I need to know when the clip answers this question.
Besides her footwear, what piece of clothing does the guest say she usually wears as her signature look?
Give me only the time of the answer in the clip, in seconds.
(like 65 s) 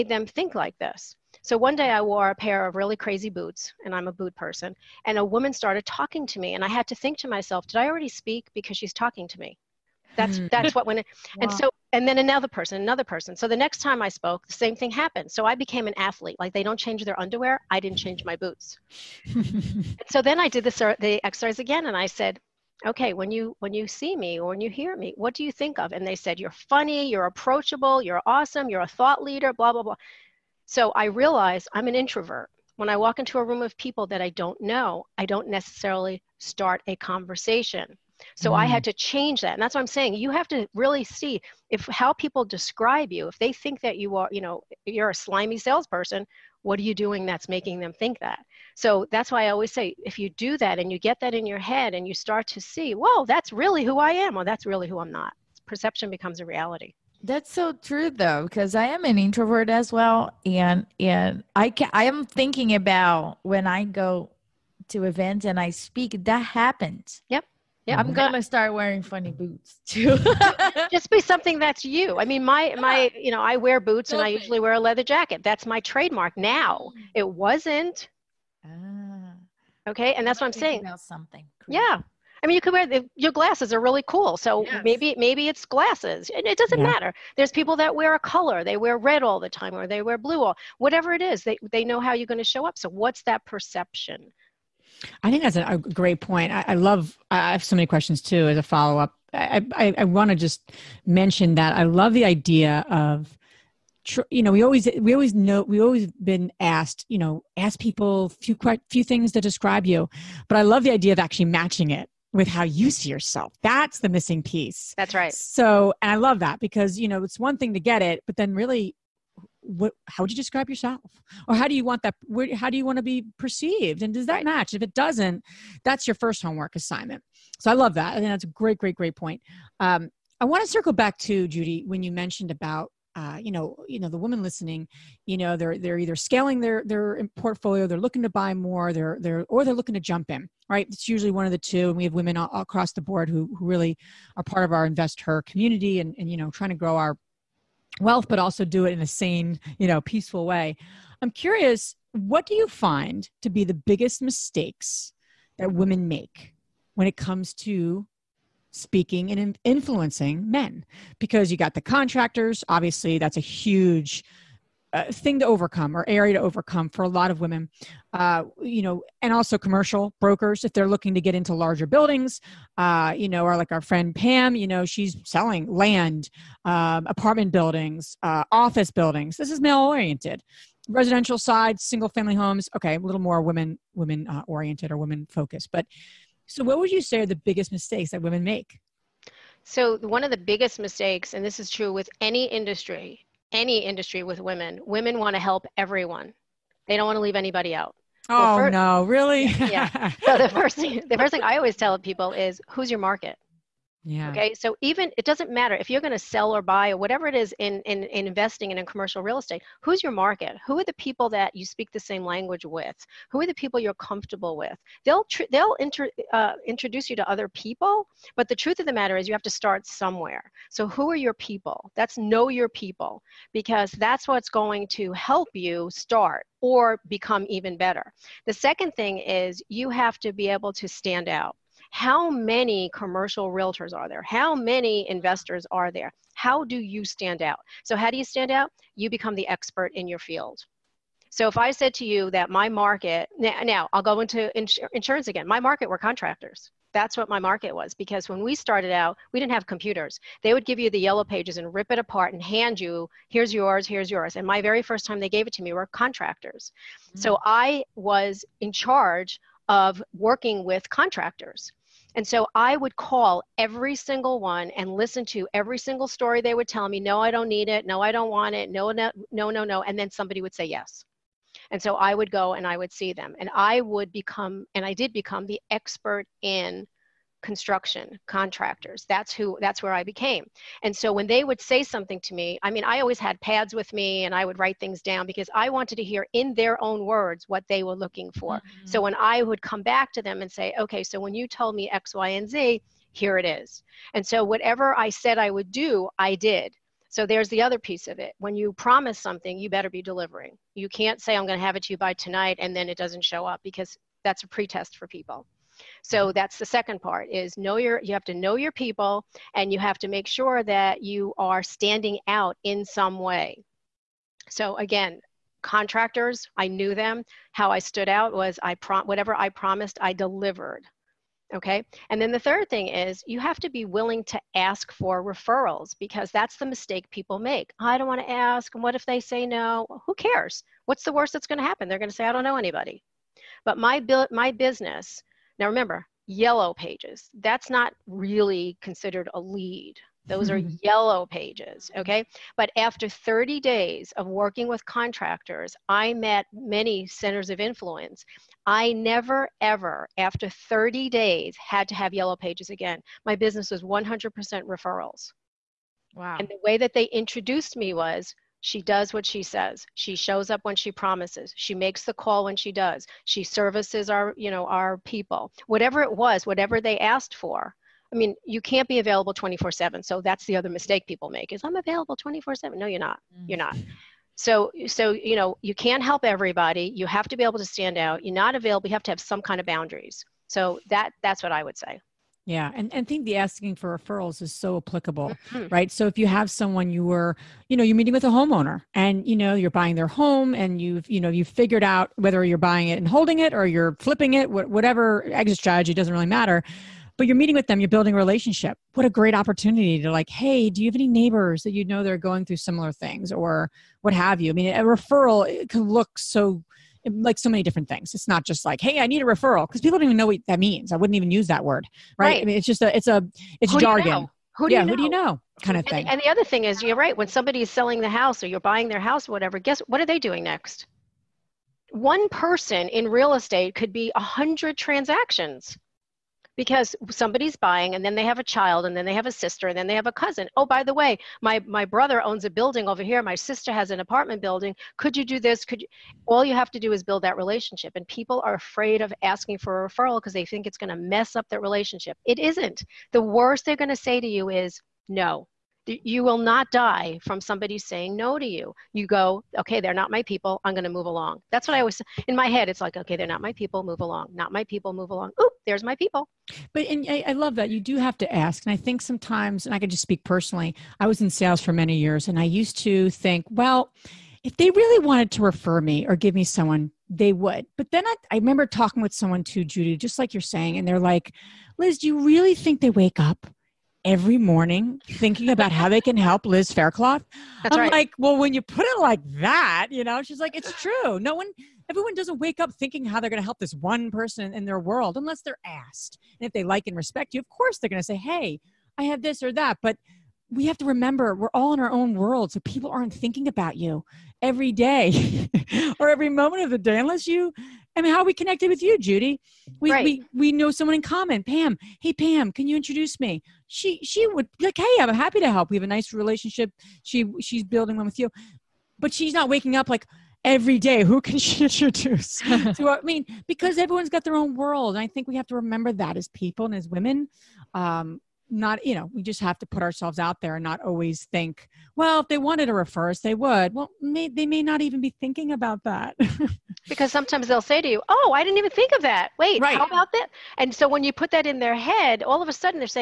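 74 s.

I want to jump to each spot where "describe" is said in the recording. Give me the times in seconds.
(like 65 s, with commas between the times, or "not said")
42 s, 109 s, 120 s.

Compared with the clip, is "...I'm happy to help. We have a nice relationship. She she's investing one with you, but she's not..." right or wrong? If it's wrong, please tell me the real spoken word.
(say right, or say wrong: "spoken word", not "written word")
wrong: "building", not "investing".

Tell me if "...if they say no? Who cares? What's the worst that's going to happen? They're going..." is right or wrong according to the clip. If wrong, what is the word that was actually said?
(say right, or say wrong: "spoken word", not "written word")
right.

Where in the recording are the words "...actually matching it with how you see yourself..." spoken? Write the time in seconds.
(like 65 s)
111 s.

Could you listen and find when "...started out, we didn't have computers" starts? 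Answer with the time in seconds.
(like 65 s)
248 s.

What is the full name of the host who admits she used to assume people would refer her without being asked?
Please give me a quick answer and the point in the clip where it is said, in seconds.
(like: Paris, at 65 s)
Liz Faircloth, at 476 s.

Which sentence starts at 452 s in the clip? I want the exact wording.
It's like, okay, they're not my people.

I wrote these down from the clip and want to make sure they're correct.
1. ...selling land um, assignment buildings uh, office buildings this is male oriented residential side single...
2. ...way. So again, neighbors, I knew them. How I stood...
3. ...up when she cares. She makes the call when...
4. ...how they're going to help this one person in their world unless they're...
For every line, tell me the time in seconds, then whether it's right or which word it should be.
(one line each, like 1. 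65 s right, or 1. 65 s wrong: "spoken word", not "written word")
1. 175 s wrong: "apartment", not "assignment"
2. 313 s wrong: "contractors", not "neighbors"
3. 360 s wrong: "promises", not "cares"
4. 483 s right.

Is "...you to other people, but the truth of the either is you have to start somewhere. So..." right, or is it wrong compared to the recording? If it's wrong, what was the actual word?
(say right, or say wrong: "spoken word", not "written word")
wrong: "matter", not "either".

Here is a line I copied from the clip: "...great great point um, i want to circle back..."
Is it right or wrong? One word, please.
right.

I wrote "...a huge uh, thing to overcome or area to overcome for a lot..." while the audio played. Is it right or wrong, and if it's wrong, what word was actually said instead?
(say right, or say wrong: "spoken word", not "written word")
right.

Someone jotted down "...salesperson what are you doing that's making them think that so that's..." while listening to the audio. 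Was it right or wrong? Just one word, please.
right.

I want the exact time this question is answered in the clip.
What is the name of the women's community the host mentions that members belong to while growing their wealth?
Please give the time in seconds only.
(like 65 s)
144 s.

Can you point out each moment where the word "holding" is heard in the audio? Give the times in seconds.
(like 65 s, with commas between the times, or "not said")
393 s.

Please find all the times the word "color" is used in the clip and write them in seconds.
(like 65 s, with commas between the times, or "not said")
88 s.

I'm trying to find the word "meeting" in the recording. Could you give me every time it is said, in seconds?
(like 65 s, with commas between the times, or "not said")
387 s, 397 s.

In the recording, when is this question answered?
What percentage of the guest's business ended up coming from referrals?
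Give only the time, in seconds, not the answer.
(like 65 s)
353 s.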